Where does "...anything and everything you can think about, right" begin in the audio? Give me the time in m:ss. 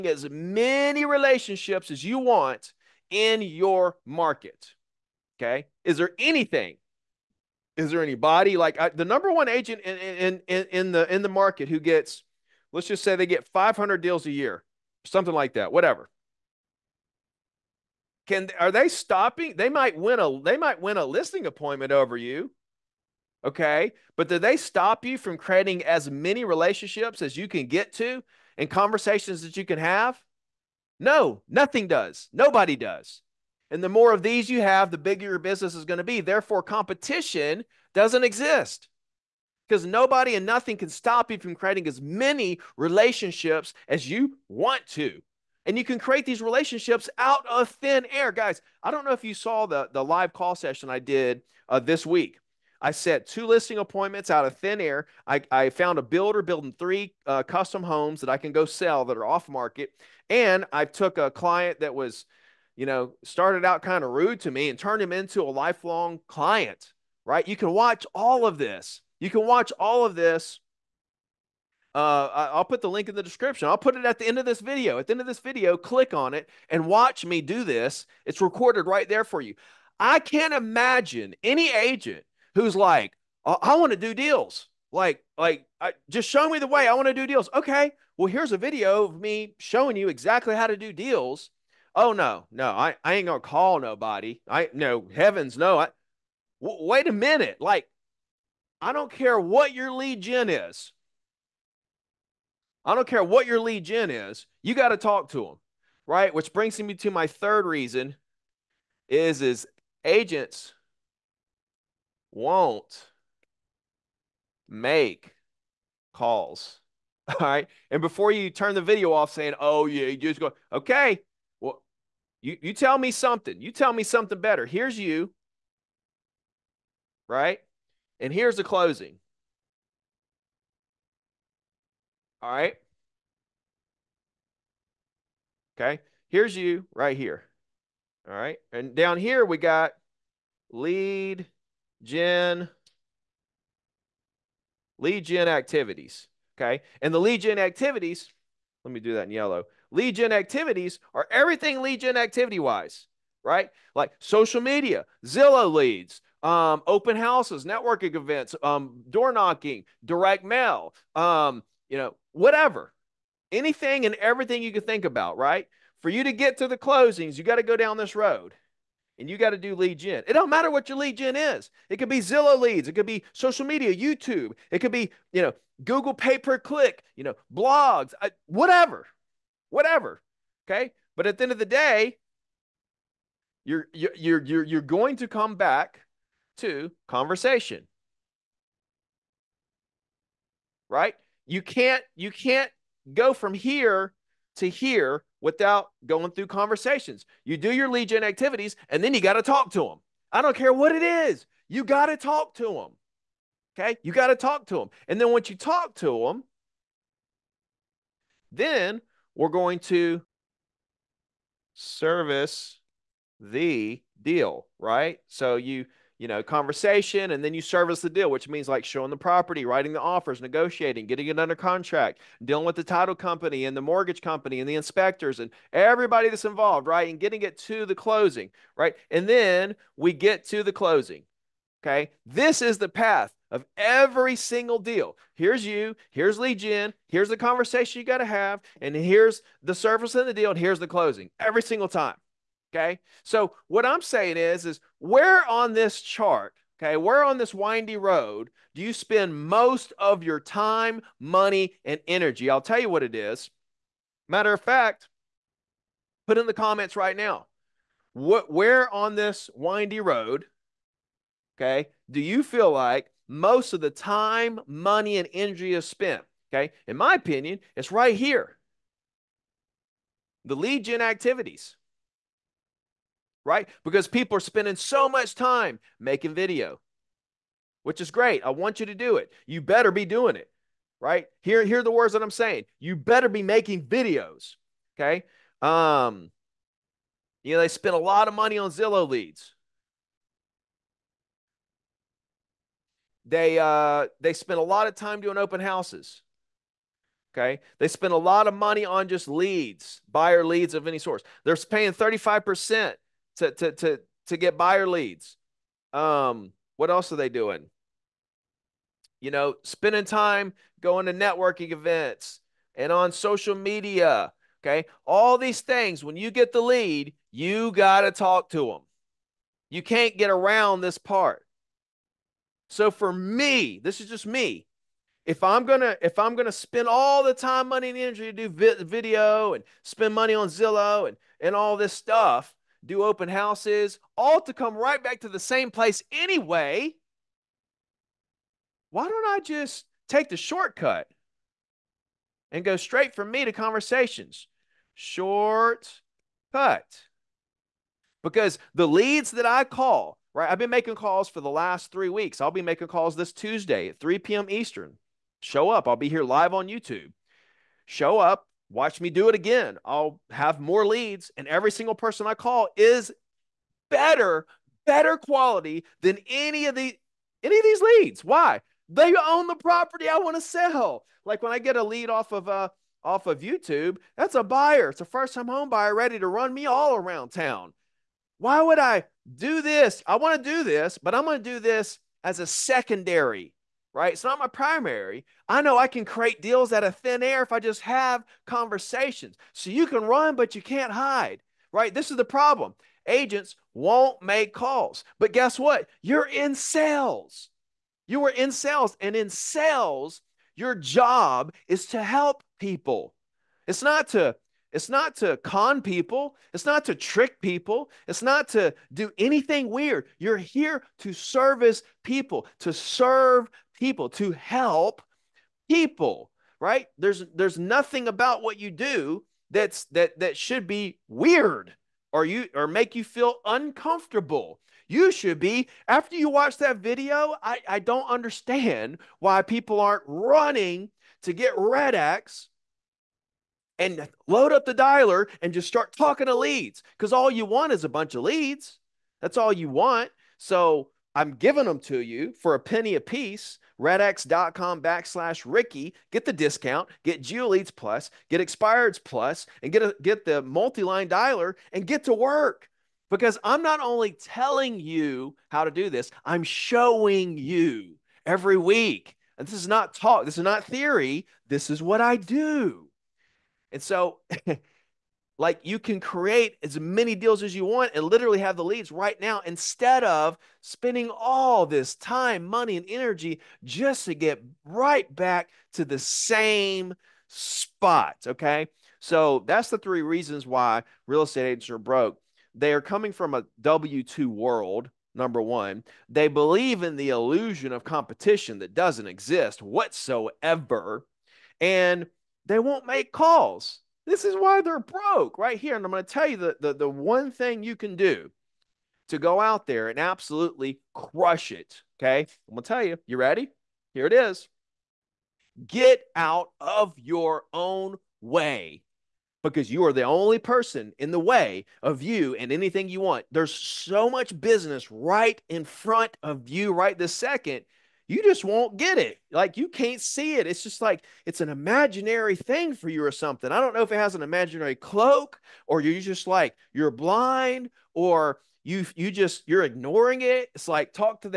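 2:43.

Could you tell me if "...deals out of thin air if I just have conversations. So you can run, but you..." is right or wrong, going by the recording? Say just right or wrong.
right.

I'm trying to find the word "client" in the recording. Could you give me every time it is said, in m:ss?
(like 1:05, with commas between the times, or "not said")
1:01, 1:06.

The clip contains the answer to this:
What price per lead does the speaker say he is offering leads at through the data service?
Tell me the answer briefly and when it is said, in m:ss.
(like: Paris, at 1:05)
a penny, at 7:22.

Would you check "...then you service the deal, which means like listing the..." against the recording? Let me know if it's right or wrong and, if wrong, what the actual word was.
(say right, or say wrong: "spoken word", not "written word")
wrong: "showing", not "listing".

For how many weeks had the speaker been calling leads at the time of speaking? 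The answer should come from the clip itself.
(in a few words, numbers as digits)
3 weeks.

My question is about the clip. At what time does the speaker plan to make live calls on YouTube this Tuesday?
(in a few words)
3 p.m. Eastern.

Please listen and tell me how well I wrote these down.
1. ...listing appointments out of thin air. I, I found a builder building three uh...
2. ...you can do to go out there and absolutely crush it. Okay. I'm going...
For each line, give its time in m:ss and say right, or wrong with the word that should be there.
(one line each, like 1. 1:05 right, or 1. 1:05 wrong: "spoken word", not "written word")
1. 0:53 right
2. 8:17 right.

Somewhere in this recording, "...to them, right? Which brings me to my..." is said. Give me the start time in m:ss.
1:45.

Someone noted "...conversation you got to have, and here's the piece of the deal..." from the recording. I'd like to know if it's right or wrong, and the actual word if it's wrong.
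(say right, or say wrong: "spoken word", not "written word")
wrong: "service", not "piece".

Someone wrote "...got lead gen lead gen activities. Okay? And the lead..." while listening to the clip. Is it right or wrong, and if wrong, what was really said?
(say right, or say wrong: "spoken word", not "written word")
right.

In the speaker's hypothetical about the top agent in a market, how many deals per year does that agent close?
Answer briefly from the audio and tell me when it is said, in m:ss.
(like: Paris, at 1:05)
500, at 0:13.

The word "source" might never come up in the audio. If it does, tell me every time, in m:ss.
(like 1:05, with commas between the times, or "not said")
5:00.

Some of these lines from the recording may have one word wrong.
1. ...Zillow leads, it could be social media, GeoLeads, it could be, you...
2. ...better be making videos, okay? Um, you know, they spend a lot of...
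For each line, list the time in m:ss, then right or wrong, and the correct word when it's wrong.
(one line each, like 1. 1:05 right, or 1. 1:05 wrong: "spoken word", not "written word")
1. 2:52 wrong: "YouTube", not "GeoLeads"
2. 4:42 right.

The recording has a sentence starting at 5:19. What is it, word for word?
You can't get around this part.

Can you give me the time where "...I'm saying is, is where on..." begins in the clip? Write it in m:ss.
4:03.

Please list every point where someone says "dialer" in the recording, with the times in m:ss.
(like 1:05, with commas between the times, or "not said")
7:14, 7:31.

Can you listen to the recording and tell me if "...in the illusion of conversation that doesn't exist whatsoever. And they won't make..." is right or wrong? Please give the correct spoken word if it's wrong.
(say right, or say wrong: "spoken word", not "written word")
wrong: "competition", not "conversation".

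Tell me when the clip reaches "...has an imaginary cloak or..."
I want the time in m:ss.
8:43.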